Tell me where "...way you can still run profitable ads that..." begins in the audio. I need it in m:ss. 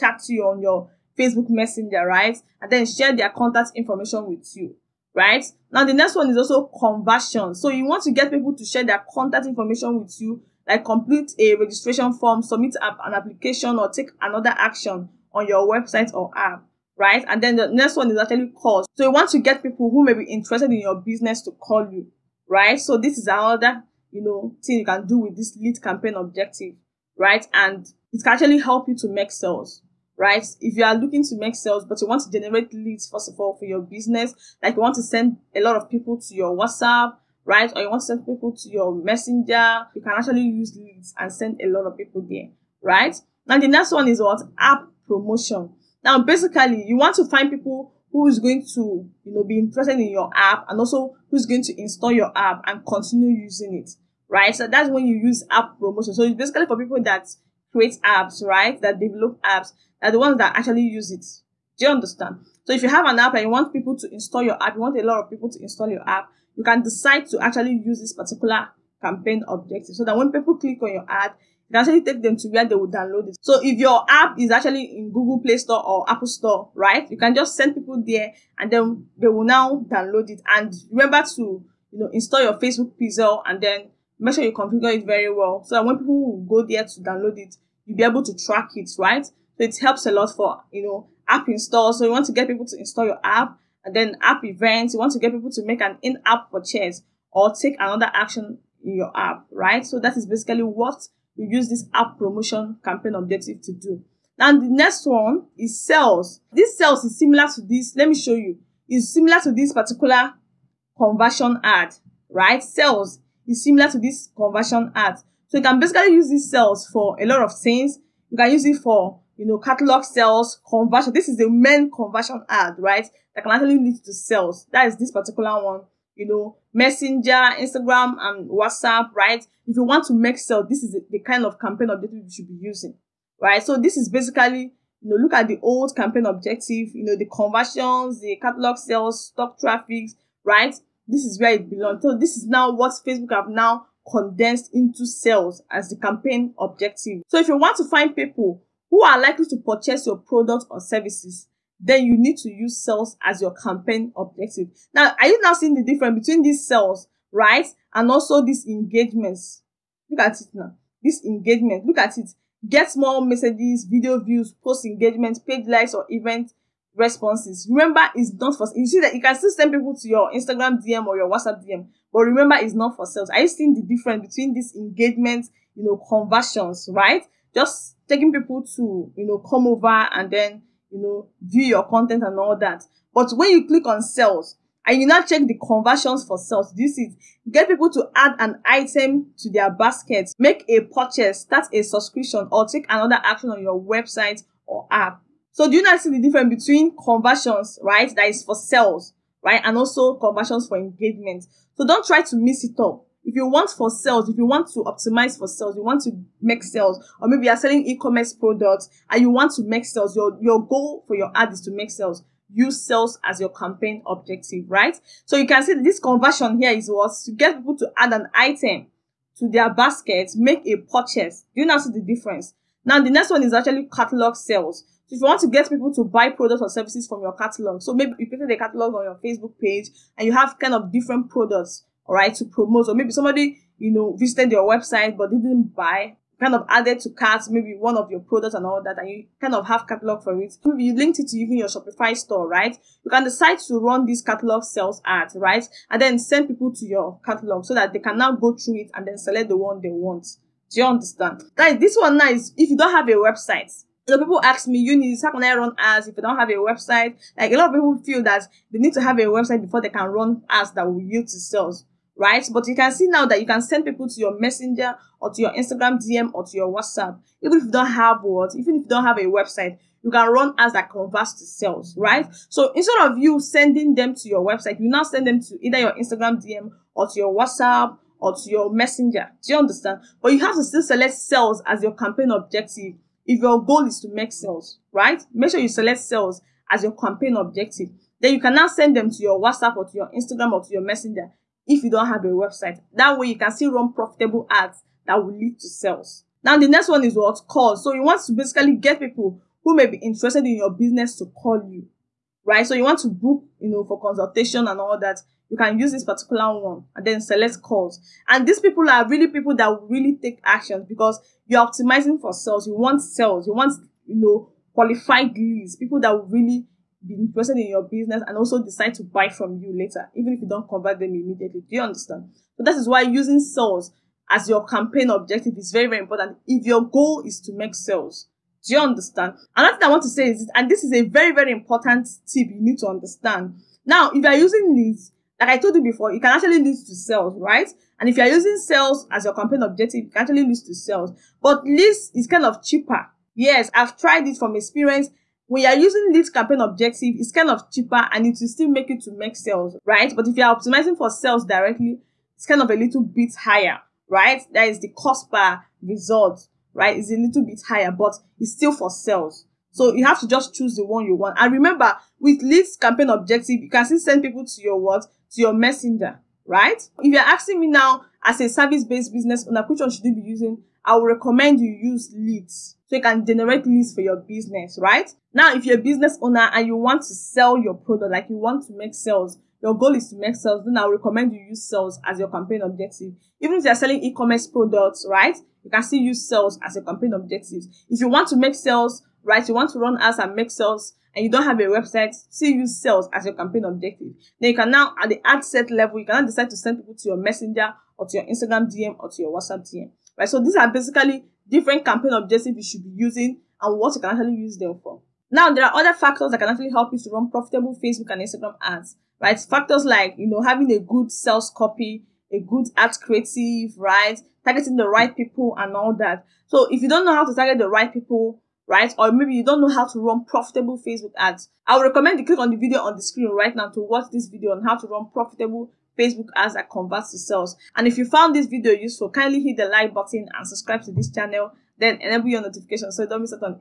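4:53.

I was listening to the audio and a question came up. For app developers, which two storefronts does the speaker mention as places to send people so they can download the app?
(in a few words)
Google Play Store or Apple Store.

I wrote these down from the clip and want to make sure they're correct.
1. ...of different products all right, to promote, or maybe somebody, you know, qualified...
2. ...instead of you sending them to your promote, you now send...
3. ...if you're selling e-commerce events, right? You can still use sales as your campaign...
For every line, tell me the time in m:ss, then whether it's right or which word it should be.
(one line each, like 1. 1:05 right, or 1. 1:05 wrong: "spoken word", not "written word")
1. 3:50 wrong: "visited", not "qualified"
2. 4:32 wrong: "website", not "promote"
3. 6:23 wrong: "products", not "events".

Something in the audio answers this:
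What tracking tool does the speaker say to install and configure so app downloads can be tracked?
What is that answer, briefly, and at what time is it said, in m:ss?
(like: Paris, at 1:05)
Facebook pixel, at 1:22.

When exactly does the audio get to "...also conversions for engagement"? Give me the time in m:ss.
3:19.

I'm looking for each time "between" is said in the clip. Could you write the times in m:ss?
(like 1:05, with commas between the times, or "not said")
2:36, 2:54, 3:16.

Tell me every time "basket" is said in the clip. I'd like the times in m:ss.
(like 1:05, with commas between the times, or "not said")
3:09, 3:39.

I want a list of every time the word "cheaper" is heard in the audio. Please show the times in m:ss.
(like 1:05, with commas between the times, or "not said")
5:42, 5:47.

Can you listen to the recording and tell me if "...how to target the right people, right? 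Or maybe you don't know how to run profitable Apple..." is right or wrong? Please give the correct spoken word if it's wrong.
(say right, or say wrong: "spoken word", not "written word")
wrong: "Facebook", not "Apple".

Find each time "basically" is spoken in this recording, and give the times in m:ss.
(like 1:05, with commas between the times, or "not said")
0:46, 0:56, 1:40, 1:55, 2:14, 4:58, 6:40.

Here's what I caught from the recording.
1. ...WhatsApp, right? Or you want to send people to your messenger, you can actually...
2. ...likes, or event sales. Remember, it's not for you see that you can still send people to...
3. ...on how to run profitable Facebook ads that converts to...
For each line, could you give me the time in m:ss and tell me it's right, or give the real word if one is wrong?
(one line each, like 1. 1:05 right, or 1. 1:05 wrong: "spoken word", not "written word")
1. 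0:36 right
2. 2:45 wrong: "responses", not "sales"
3. 7:04 right.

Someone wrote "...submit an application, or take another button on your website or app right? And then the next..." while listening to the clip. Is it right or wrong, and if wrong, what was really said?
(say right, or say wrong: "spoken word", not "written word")
wrong: "action", not "button".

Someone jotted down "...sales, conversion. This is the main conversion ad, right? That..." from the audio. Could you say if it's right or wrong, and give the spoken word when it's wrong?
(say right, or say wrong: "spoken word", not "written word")
right.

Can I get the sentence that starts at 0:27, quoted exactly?
And it can actually help you to make sales, right?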